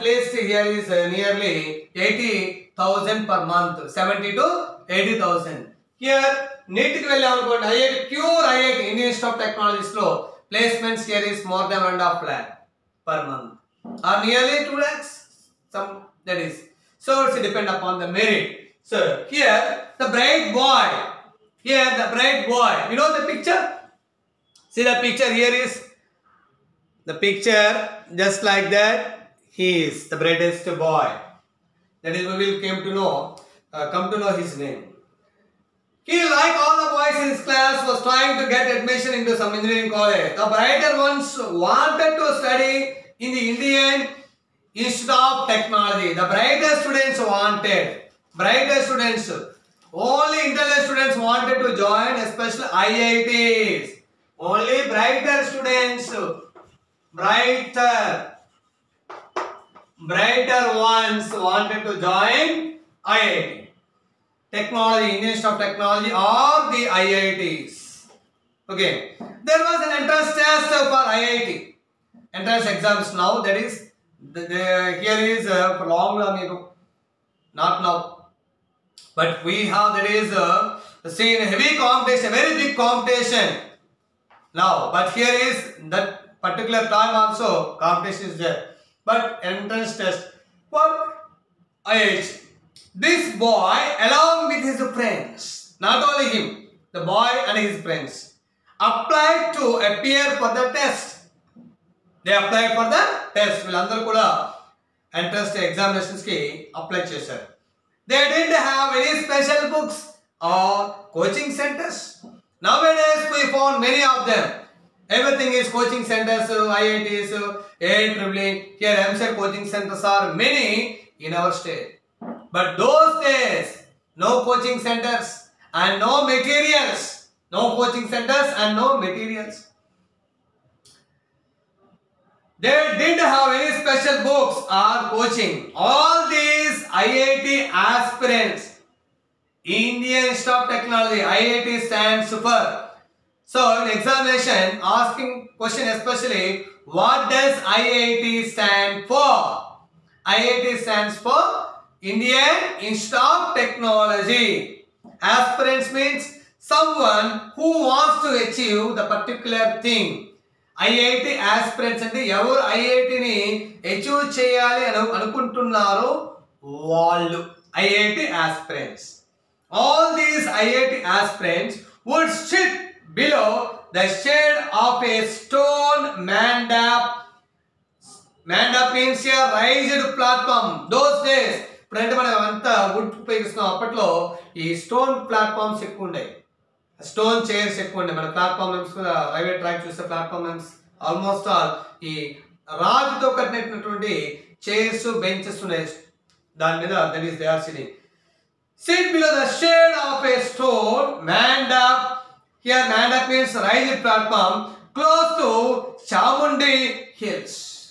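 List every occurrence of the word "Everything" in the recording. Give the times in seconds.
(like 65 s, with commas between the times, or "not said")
115 s.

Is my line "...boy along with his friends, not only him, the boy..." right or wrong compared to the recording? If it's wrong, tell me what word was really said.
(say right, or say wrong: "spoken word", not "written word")
right.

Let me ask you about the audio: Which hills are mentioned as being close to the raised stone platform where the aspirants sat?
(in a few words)
Chamundi Hills.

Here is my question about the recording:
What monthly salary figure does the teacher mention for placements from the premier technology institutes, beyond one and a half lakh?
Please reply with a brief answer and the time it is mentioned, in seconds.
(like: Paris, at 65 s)
nearly 2 lakhs, at 14 s.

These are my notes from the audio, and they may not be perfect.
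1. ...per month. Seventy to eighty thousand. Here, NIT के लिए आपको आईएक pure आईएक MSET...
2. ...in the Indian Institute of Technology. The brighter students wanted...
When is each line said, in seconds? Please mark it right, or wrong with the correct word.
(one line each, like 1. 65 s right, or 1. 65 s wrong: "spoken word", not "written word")
1. 3 s wrong: "Indian", not "MSET"
2. 43 s right.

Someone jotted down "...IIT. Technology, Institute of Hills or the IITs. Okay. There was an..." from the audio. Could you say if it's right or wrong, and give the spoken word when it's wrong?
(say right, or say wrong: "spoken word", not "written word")
wrong: "Technology", not "Hills".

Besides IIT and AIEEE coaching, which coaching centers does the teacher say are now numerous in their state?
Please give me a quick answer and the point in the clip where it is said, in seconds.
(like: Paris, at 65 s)
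MSET, at 119 s.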